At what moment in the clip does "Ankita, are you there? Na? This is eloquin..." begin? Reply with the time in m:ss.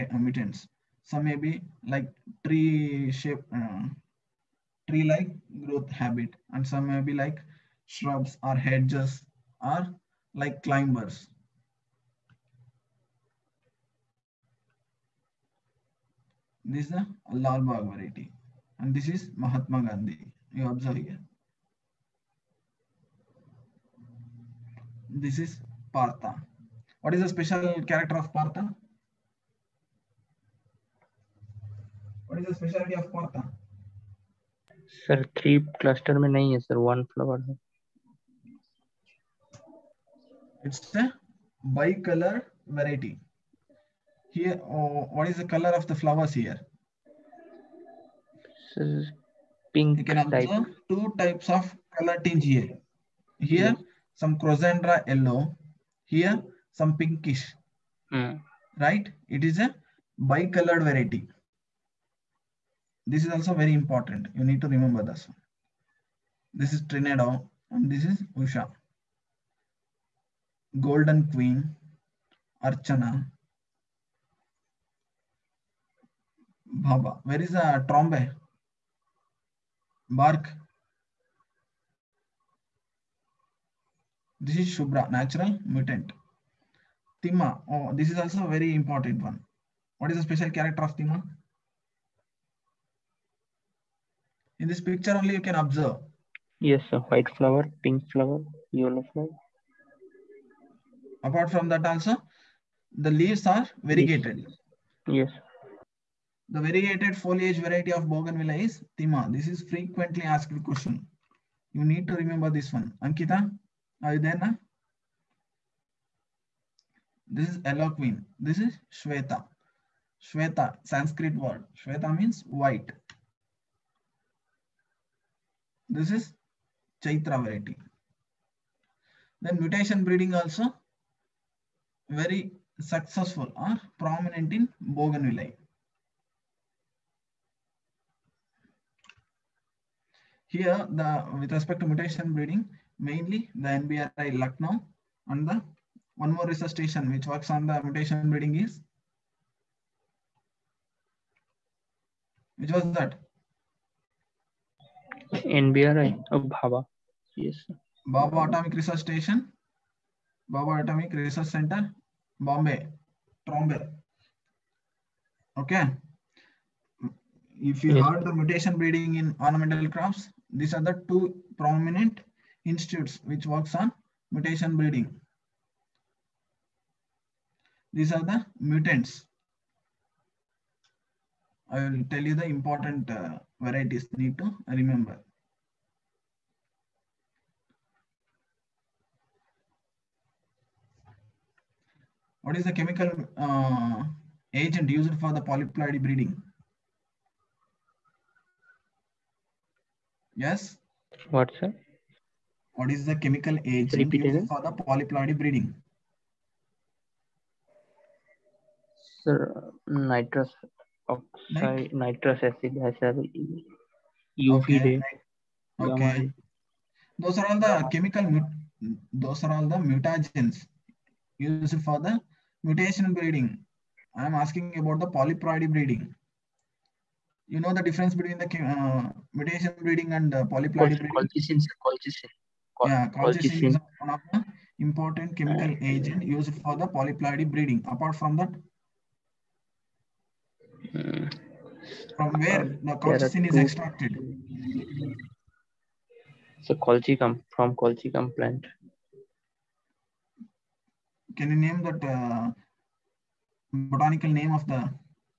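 1:53.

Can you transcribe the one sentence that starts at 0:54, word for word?
some crossandra yellow here some pinkish mm.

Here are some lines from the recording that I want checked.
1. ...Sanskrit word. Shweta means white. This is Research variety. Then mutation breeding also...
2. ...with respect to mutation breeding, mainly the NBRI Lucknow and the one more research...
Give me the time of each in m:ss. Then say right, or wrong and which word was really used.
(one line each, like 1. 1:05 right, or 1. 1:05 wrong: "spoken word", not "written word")
1. 2:00 wrong: "Chaitra", not "Research"
2. 2:21 right.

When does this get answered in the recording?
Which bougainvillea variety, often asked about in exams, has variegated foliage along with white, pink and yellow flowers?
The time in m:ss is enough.
1:46.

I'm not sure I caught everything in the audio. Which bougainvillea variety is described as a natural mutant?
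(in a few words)
Shubra.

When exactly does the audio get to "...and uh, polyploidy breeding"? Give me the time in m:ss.
3:50.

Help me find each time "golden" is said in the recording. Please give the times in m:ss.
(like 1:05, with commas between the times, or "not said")
1:10.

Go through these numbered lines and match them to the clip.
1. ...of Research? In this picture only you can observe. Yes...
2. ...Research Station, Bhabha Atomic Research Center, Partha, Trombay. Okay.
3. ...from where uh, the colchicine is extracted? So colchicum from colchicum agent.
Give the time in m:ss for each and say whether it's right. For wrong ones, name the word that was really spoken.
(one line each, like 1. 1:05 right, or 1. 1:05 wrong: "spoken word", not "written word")
1. 1:30 wrong: "Tima", not "Research"
2. 2:38 wrong: "Bombay", not "Partha"
3. 4:02 wrong: "plant", not "agent".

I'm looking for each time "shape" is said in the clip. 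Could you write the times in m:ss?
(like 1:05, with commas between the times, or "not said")
0:03.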